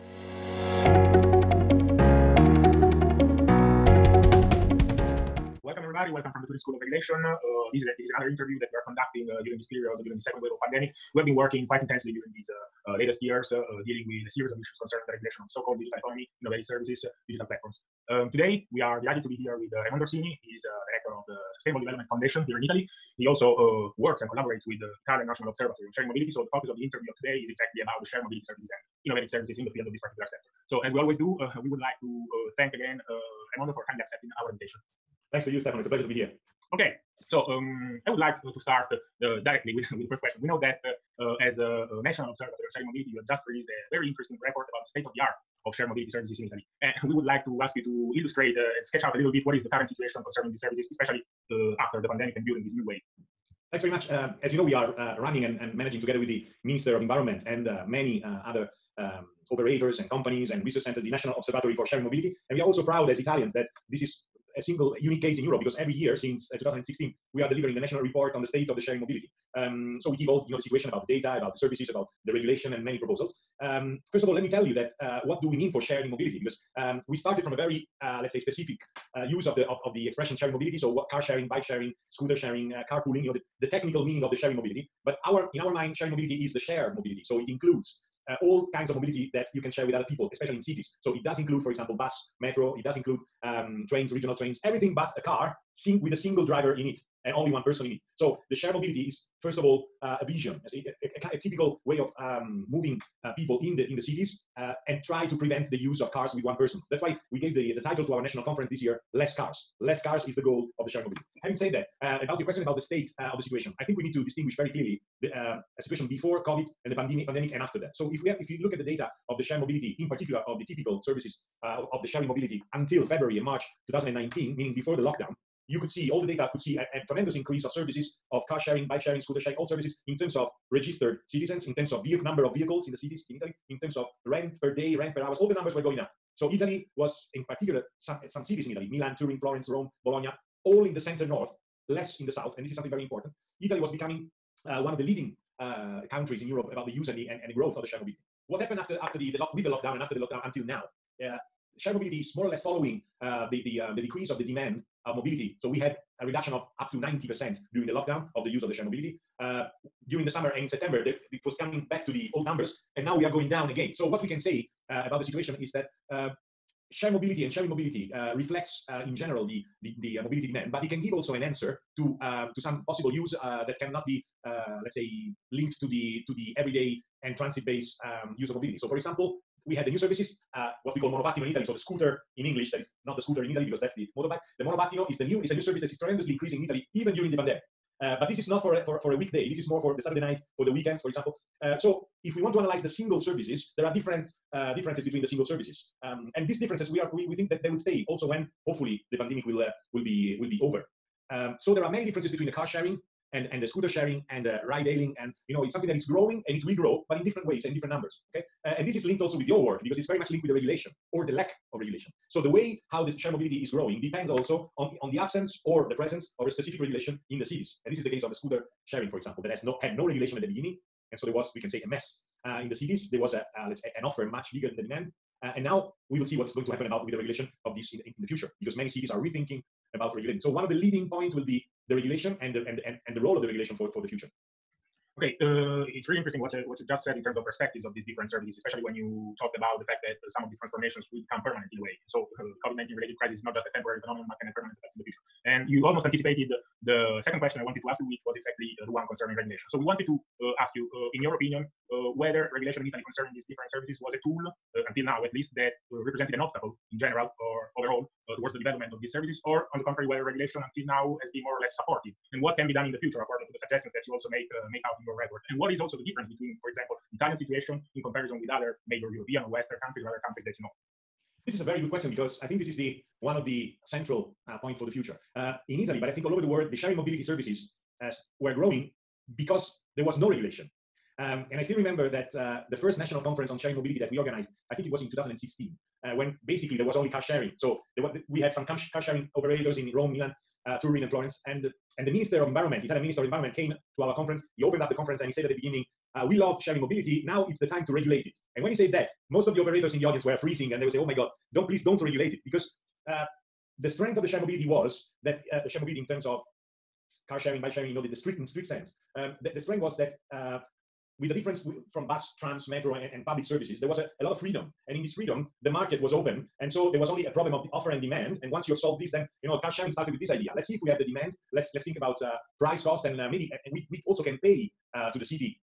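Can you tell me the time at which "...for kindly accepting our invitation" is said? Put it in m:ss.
0:33.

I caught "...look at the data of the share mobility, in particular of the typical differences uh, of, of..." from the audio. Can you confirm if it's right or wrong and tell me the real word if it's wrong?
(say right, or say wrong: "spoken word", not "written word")
wrong: "services", not "differences".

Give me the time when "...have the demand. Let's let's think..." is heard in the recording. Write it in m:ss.
5:20.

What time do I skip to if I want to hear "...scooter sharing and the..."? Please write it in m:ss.
3:23.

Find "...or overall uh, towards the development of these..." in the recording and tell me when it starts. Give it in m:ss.
4:17.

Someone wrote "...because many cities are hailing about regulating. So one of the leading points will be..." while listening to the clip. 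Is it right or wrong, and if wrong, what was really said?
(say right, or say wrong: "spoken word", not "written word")
wrong: "rethinking", not "hailing".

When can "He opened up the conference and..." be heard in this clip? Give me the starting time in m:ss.
4:54.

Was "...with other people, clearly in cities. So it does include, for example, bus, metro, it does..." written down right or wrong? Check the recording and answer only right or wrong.
wrong.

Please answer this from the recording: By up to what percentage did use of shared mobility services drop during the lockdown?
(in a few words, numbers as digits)
90%.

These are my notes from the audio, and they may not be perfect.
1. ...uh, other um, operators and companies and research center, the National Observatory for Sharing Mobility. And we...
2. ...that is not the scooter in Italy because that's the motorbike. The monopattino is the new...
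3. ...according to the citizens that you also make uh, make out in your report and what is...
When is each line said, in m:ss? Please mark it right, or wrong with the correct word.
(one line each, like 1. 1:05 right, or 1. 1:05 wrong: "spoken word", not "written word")
1. 0:58 right
2. 3:02 right
3. 4:23 wrong: "suggestions", not "citizens".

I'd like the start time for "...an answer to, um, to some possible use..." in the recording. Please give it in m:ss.
2:51.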